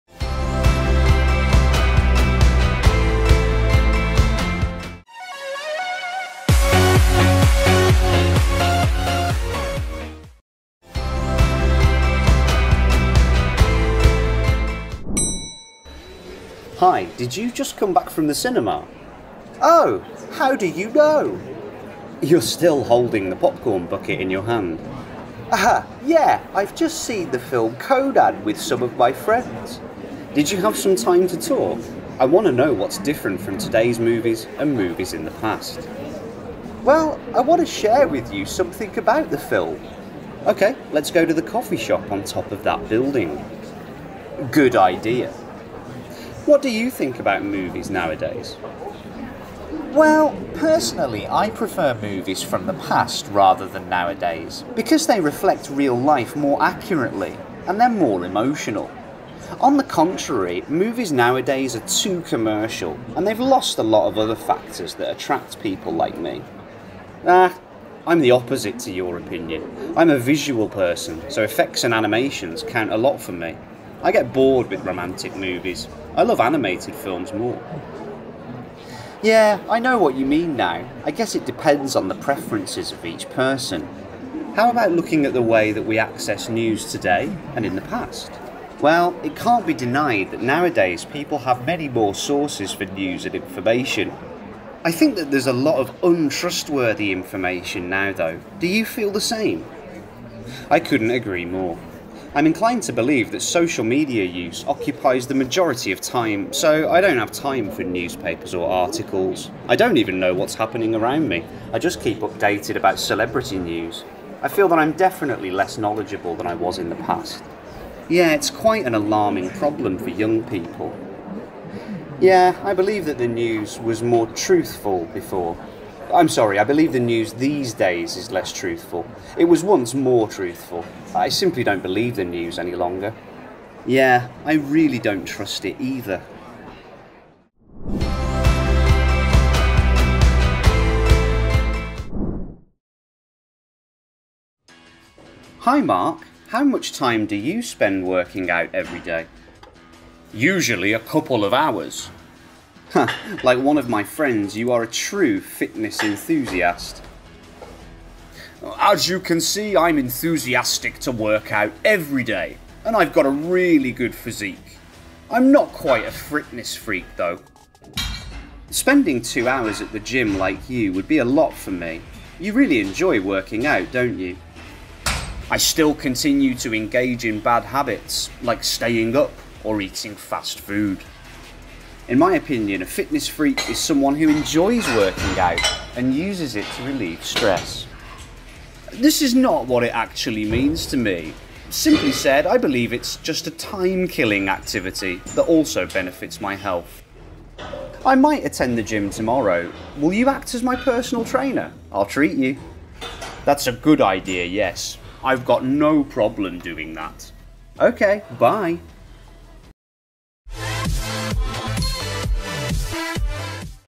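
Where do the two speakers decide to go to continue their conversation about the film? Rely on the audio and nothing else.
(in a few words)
the coffee shop.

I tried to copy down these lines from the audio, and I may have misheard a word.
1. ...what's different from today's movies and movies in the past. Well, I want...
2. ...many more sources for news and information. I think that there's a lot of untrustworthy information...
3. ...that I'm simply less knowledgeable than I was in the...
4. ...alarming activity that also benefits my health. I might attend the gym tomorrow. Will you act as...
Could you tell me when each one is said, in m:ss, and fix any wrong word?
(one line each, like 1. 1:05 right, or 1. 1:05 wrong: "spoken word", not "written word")
1. 0:32 right
2. 1:31 right
3. 1:54 wrong: "definitely", not "simply"
4. 3:14 wrong: "killing", not "alarming".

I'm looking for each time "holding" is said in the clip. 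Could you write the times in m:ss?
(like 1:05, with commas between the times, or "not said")
0:22.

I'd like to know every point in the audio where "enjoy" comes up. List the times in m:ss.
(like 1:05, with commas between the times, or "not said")
2:52, 3:04.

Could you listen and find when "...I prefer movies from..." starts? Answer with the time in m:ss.
0:51.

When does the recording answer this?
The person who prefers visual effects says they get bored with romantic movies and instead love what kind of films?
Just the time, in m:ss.
1:16.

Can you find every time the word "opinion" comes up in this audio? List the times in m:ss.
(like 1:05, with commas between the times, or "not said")
1:09, 3:02.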